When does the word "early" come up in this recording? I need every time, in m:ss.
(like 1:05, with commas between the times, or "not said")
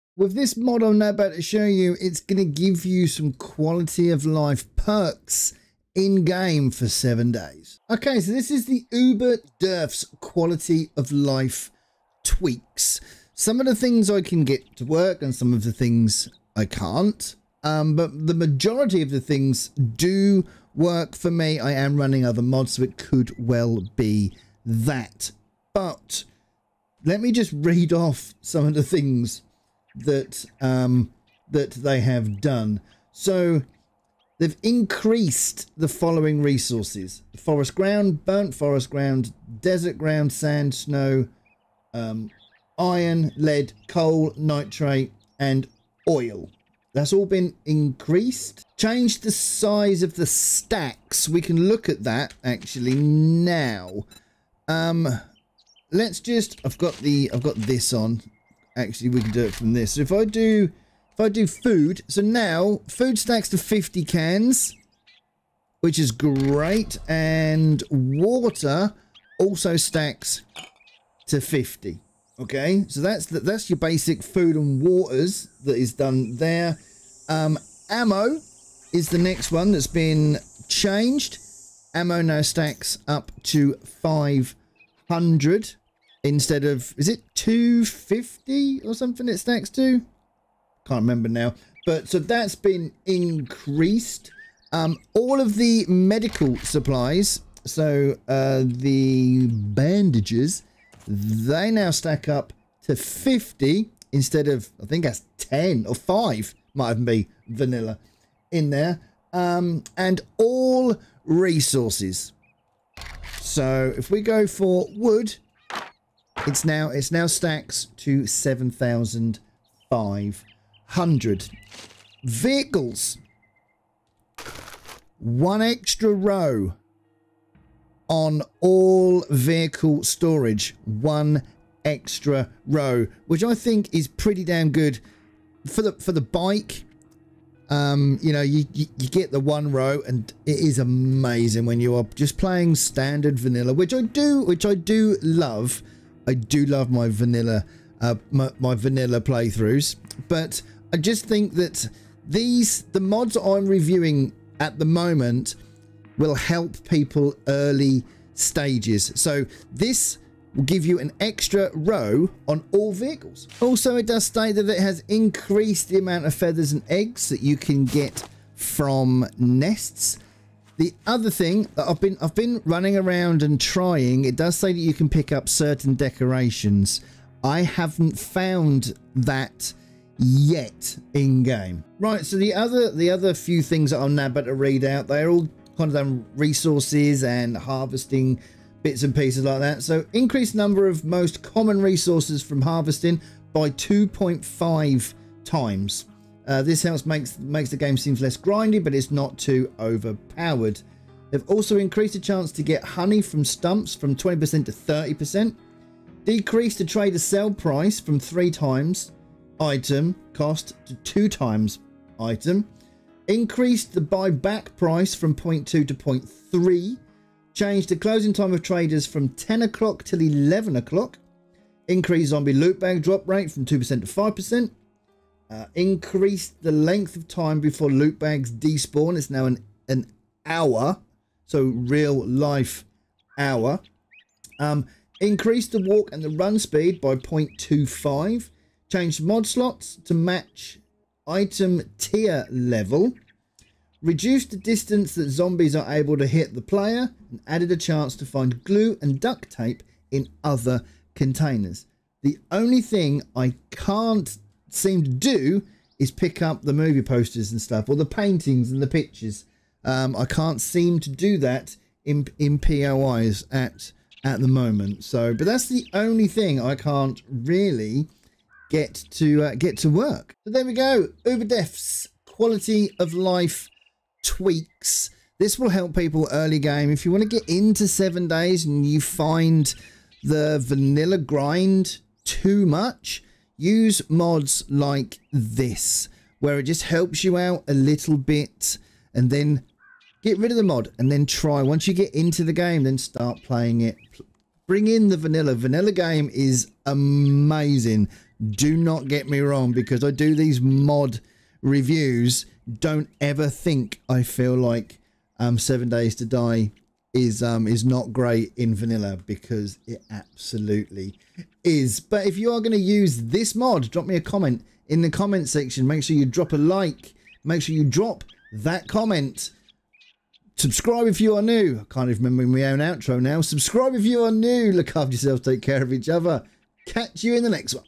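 2:37, 4:36.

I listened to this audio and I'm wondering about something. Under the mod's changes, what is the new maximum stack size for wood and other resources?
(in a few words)
7,500.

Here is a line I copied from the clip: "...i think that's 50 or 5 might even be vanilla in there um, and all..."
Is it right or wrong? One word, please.
wrong.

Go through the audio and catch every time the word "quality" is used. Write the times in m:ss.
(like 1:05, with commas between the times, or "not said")
0:03, 0:10, 4:32.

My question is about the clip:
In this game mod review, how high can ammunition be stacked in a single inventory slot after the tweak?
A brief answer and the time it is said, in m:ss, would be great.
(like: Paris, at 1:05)
500, at 1:24.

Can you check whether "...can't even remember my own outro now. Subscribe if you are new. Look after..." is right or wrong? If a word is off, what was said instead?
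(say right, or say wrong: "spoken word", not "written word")
right.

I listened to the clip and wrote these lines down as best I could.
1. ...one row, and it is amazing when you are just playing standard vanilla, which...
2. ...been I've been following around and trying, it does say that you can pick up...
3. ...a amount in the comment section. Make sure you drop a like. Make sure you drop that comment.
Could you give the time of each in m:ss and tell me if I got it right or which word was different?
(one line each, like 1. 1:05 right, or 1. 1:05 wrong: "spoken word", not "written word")
1. 2:19 right
2. 2:52 wrong: "running", not "following"
3. 5:14 wrong: "comment", not "amount".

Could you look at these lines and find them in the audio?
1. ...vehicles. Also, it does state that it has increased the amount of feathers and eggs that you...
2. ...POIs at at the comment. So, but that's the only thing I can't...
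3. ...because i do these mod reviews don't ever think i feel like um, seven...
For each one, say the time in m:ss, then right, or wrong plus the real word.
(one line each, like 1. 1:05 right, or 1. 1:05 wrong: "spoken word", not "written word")
1. 2:42 right
2. 4:22 wrong: "moment", not "comment"
3. 4:59 right.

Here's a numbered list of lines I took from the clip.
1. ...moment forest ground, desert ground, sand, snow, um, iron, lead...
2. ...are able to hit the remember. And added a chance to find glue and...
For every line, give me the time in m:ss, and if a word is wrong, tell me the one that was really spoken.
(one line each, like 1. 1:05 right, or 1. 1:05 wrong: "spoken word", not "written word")
1. 0:38 wrong: "burnt", not "moment"
2. 4:05 wrong: "player", not "remember".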